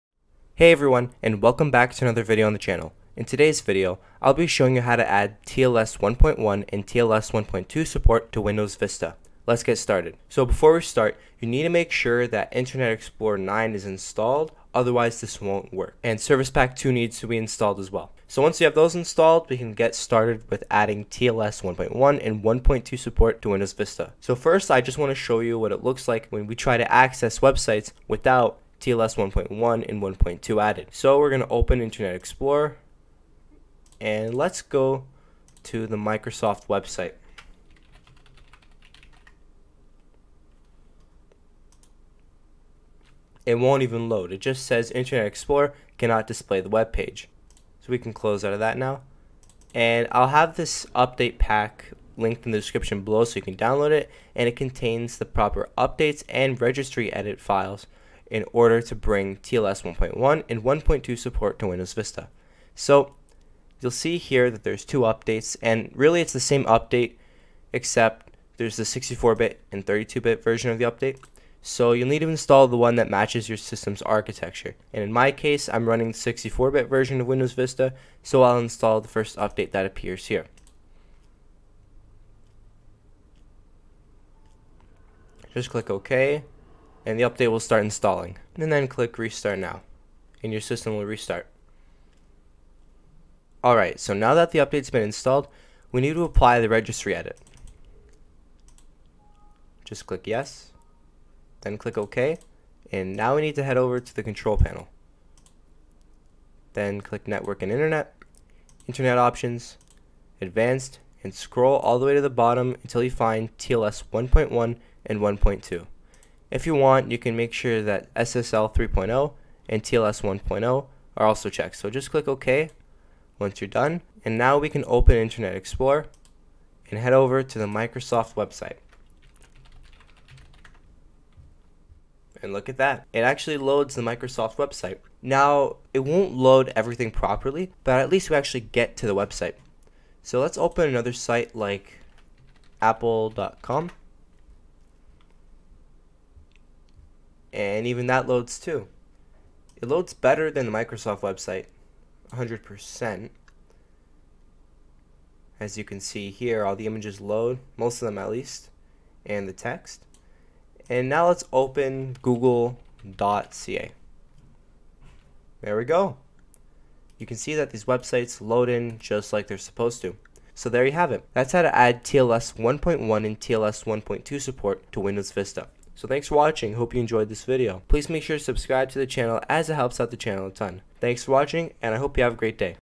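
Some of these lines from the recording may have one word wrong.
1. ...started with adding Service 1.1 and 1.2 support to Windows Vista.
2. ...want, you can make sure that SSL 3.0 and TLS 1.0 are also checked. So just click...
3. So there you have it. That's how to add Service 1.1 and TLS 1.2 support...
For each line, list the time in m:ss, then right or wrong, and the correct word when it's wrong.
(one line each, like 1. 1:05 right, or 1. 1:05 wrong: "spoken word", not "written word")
1. 0:19 wrong: "TLS", not "Service"
2. 1:56 right
3. 2:50 wrong: "TLS", not "Service".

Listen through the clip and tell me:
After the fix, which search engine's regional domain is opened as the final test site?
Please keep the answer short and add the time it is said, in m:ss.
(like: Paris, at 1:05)
google.ca, at 2:42.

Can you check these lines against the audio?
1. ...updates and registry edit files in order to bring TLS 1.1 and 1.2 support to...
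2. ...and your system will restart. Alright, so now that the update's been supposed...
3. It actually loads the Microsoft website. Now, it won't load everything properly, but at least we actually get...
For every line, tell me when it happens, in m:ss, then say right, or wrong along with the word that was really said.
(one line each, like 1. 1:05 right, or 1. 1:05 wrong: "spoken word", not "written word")
1. 0:55 right
2. 1:30 wrong: "installed", not "supposed"
3. 2:13 right.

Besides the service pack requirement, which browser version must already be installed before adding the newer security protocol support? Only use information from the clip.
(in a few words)
Internet Explorer 9.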